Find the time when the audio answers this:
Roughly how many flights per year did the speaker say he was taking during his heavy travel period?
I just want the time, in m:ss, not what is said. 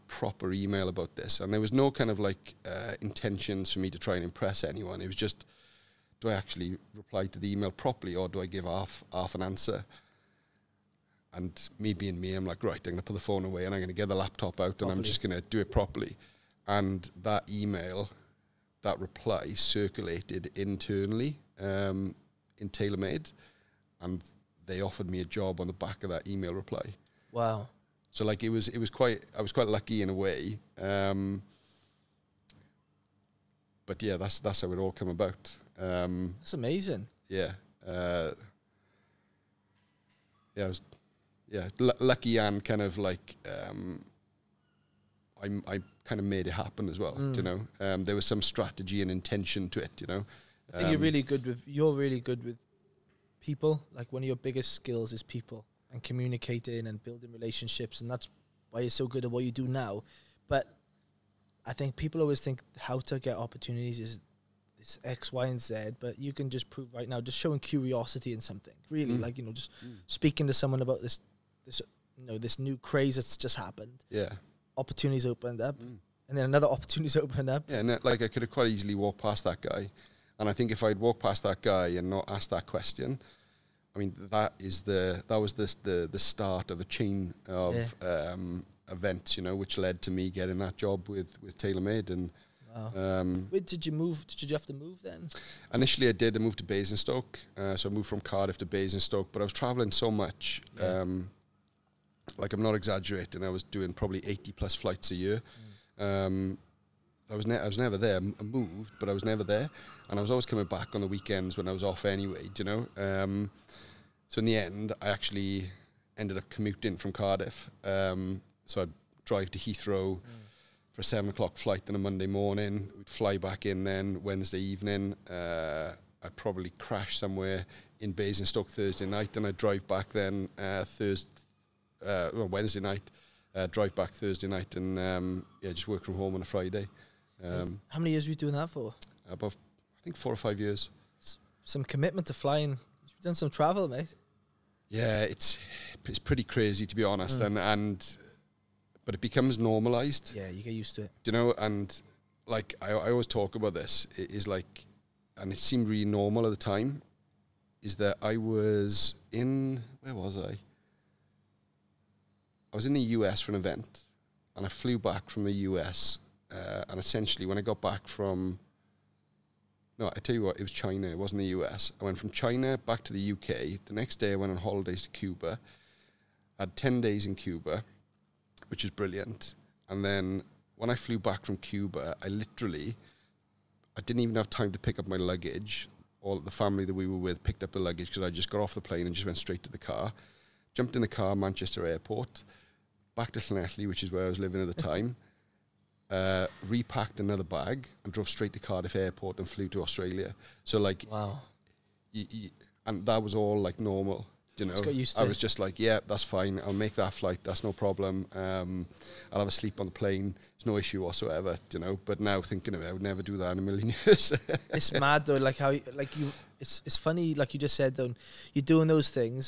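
1:44.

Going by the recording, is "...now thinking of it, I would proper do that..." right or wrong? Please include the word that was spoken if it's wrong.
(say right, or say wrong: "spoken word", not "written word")
wrong: "never", not "proper".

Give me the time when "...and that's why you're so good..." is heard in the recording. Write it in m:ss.
0:58.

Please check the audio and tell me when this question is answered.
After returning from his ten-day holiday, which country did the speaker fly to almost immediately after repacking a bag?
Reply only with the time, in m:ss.
3:19.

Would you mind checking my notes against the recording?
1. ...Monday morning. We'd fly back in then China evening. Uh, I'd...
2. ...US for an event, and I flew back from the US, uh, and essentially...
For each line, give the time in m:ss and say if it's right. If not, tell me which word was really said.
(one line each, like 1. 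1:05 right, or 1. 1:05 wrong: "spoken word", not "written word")
1. 2:01 wrong: "Wednesday", not "China"
2. 2:43 right.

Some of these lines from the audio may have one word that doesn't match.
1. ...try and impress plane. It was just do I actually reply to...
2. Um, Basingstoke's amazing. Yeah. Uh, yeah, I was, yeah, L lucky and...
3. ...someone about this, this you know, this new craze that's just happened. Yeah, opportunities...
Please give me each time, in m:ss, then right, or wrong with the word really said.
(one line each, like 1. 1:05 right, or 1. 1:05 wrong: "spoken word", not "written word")
1. 0:03 wrong: "anyone", not "plane"
2. 0:35 wrong: "That", not "Basingstoke"
3. 1:10 right.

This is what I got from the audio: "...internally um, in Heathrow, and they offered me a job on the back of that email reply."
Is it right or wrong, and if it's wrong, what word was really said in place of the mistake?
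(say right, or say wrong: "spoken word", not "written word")
wrong: "TaylorMade", not "Heathrow".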